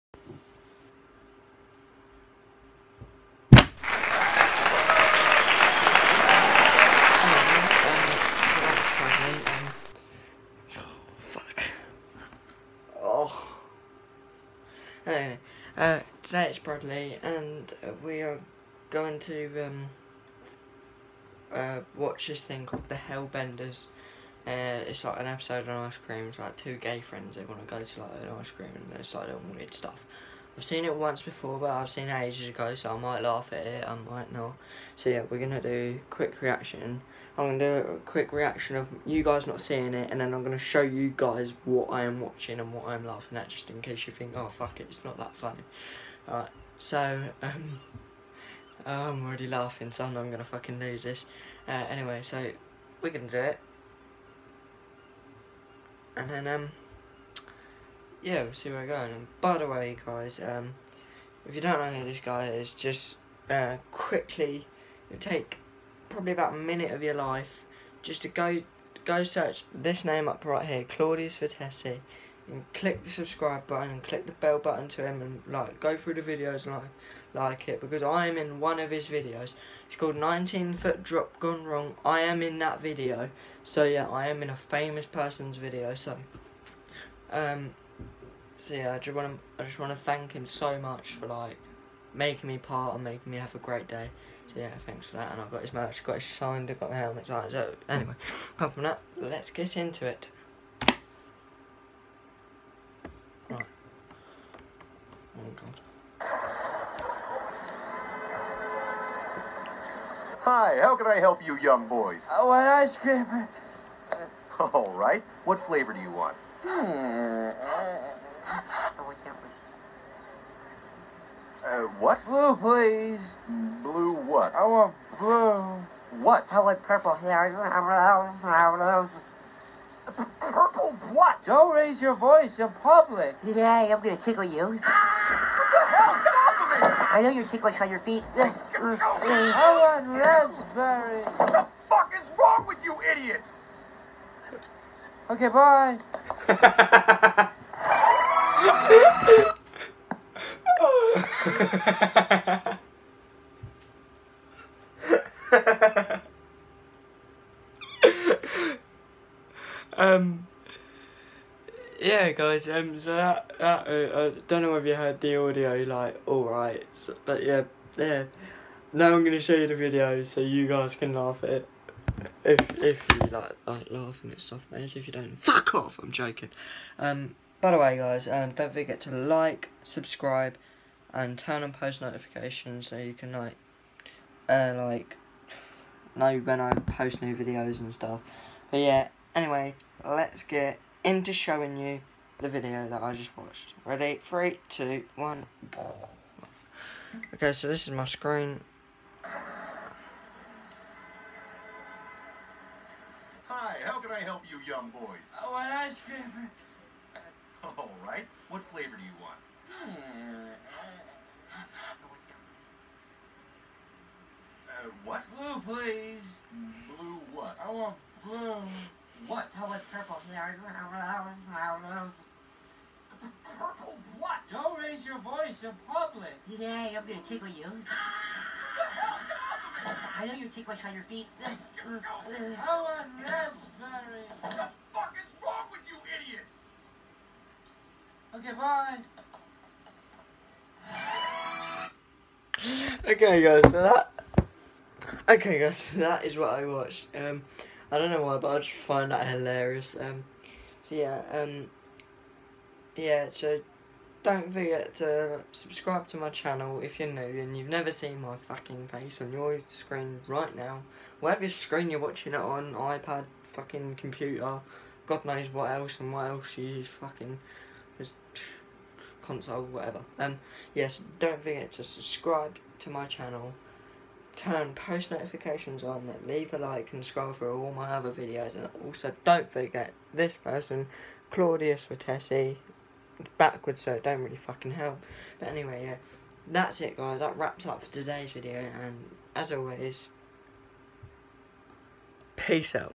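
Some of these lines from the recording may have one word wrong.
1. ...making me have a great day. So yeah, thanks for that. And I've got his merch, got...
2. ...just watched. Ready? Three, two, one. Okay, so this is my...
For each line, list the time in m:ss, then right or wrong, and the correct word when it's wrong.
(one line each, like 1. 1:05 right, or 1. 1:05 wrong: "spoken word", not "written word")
1. 1:33 right
2. 3:13 right.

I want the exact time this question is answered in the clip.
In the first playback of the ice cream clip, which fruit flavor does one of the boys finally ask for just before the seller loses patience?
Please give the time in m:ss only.
2:20.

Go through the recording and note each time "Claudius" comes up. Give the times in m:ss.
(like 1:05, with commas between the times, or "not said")
1:10, 4:41.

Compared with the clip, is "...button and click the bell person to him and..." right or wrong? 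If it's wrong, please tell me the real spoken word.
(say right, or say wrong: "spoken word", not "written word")
wrong: "button", not "person".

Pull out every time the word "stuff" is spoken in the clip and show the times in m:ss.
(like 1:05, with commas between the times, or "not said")
0:29, 2:54, 3:07.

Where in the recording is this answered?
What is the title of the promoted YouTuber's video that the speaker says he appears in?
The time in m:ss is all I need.
1:20.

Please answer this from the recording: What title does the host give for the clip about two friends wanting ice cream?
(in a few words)
The Hellbenders.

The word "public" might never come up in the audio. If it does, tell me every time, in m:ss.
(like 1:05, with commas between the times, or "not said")
2:12, 3:45.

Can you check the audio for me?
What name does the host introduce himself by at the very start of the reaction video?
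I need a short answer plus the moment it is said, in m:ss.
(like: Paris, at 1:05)
Bradley, at 0:16.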